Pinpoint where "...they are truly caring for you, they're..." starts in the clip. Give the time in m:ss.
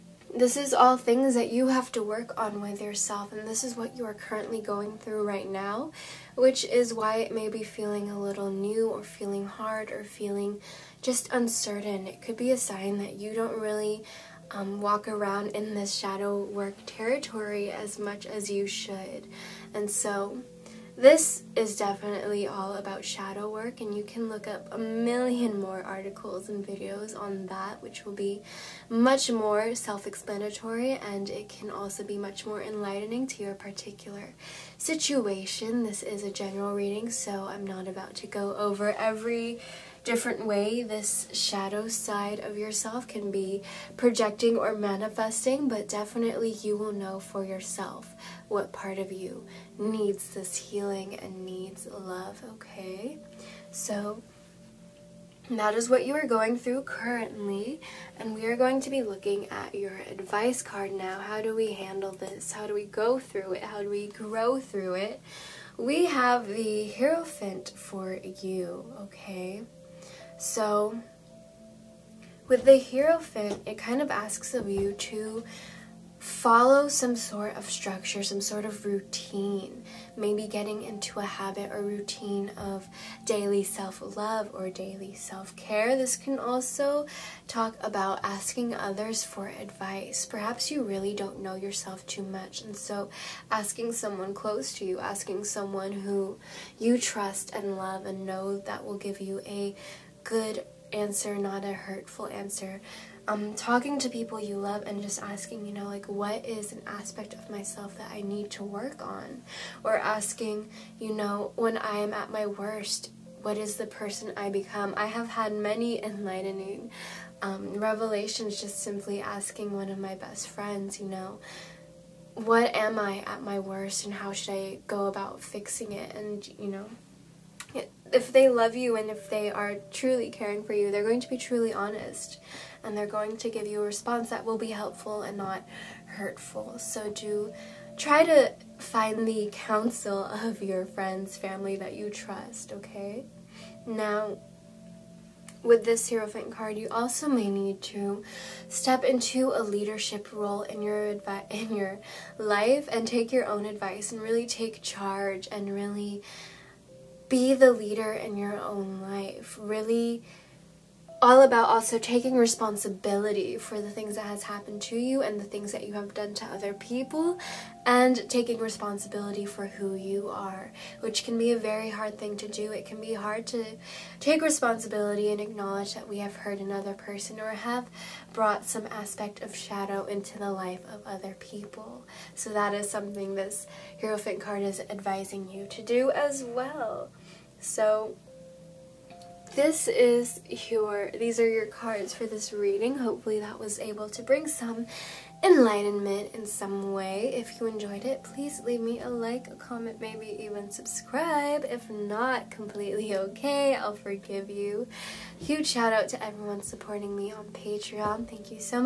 2:09.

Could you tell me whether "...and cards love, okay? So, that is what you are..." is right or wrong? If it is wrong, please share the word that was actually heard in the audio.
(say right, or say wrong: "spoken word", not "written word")
wrong: "needs", not "cards".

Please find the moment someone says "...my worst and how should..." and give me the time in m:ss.
2:03.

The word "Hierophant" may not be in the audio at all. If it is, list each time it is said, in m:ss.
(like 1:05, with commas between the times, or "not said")
1:06, 1:12, 2:26, 3:03.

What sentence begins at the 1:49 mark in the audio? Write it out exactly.
Or asking, you know, when I am at my worst, what is the person I become?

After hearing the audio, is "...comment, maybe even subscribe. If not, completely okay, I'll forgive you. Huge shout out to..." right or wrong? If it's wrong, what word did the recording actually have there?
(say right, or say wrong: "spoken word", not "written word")
right.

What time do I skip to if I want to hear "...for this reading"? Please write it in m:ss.
3:12.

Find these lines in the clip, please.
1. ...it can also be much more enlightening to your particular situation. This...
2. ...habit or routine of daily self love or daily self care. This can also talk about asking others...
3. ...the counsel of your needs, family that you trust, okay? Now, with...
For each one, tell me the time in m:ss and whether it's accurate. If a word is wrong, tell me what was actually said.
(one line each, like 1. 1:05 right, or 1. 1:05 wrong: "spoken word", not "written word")
1. 0:31 right
2. 1:21 right
3. 2:19 wrong: "friends", not "needs".